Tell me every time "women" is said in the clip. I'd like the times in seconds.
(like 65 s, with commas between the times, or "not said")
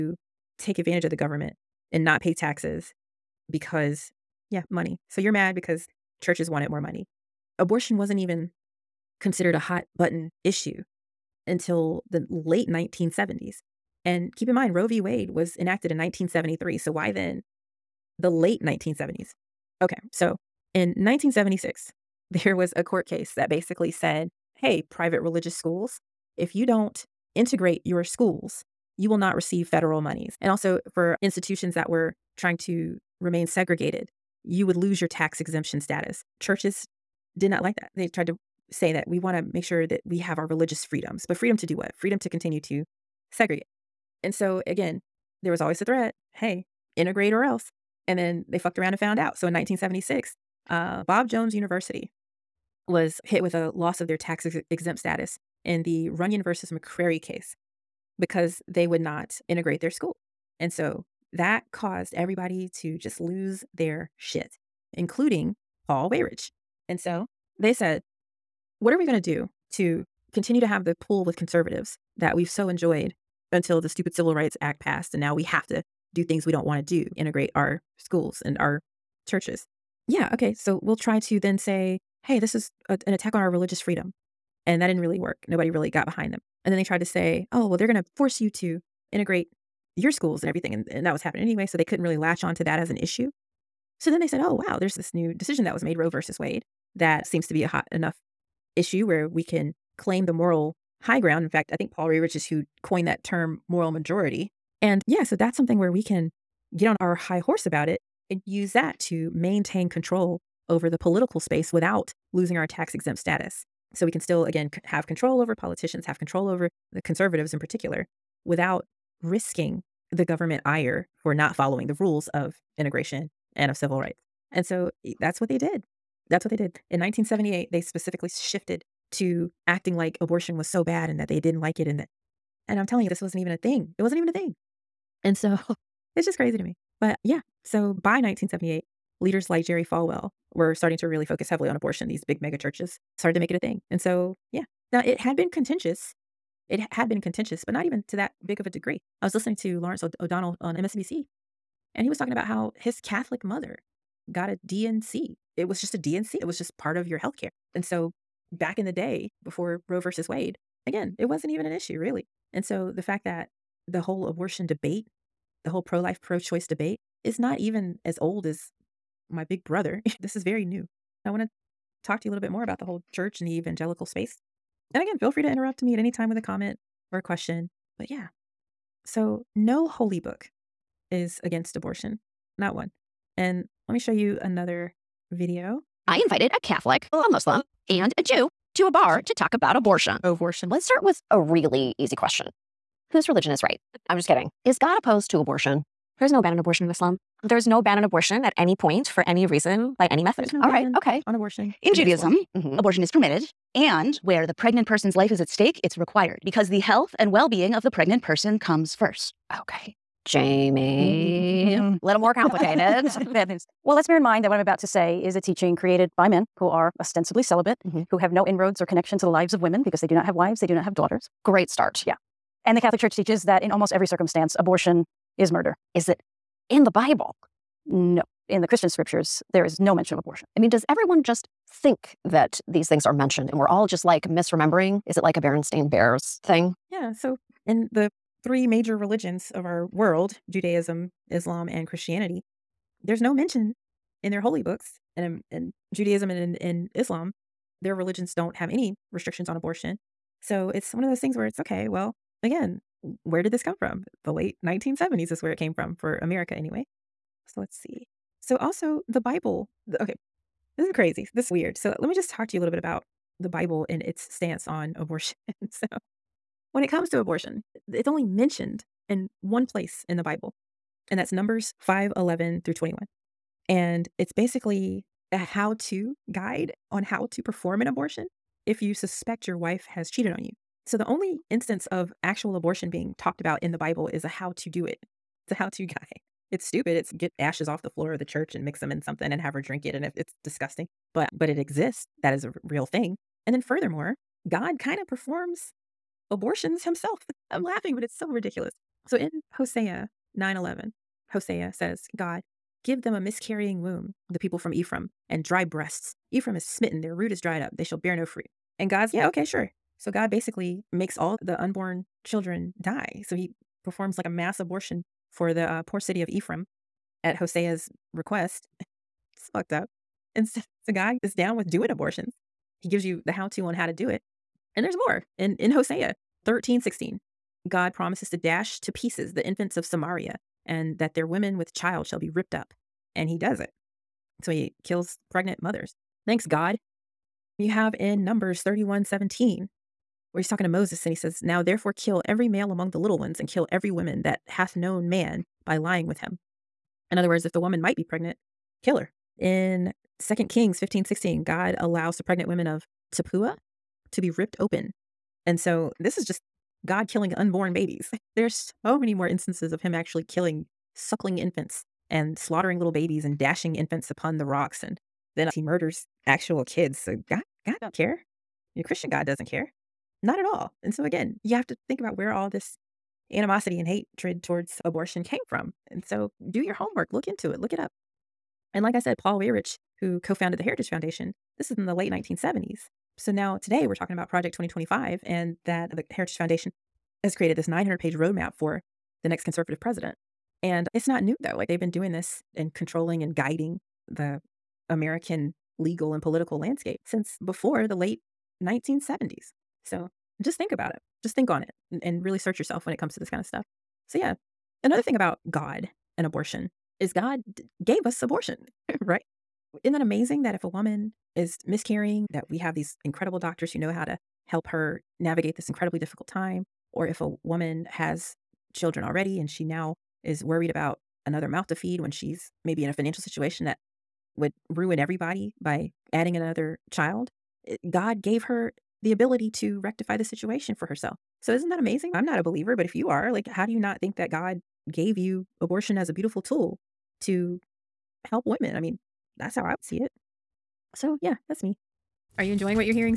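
219 s, 331 s, 352 s, 438 s.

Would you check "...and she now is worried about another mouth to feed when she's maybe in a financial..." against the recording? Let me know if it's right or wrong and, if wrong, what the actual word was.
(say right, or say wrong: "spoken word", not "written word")
right.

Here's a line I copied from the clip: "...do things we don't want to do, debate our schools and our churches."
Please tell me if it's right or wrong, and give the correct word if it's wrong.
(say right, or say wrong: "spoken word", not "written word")
wrong: "integrate", not "debate".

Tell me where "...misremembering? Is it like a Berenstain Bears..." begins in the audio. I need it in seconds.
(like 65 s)
234 s.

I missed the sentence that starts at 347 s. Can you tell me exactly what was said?
In other words, if the woman might be pregnant, kill her.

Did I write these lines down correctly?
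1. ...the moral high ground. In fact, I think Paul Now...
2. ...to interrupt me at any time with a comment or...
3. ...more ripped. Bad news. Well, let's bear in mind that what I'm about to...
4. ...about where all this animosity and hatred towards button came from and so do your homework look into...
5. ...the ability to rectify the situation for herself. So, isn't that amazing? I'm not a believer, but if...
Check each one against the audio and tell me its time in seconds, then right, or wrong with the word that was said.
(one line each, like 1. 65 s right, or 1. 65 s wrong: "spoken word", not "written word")
1. 100 s wrong: "Rerich", not "Now"
2. 175 s right
3. 212 s wrong: "complicated", not "ripped"
4. 372 s wrong: "abortion", not "button"
5. 429 s right.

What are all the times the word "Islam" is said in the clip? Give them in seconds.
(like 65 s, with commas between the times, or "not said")
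196 s, 241 s, 246 s.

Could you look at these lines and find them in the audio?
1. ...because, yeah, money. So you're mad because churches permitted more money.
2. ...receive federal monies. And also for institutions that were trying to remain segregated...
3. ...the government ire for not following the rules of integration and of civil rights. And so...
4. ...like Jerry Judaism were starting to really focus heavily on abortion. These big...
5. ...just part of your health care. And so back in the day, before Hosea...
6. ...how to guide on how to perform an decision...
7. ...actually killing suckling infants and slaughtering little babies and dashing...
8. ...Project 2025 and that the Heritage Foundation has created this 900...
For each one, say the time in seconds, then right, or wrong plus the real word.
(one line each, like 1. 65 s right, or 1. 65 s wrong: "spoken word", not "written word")
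1. 3 s wrong: "wanted", not "permitted"
2. 29 s right
3. 120 s right
4. 139 s wrong: "Falwell", not "Judaism"
5. 156 s wrong: "Roe", not "Hosea"
6. 275 s wrong: "abortion", not "decision"
7. 359 s right
8. 384 s right.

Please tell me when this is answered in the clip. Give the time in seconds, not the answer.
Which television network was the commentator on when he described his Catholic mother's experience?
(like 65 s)
150 s.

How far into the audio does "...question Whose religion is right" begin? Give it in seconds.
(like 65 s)
192 s.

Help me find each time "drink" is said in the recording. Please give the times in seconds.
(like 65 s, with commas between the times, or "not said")
289 s.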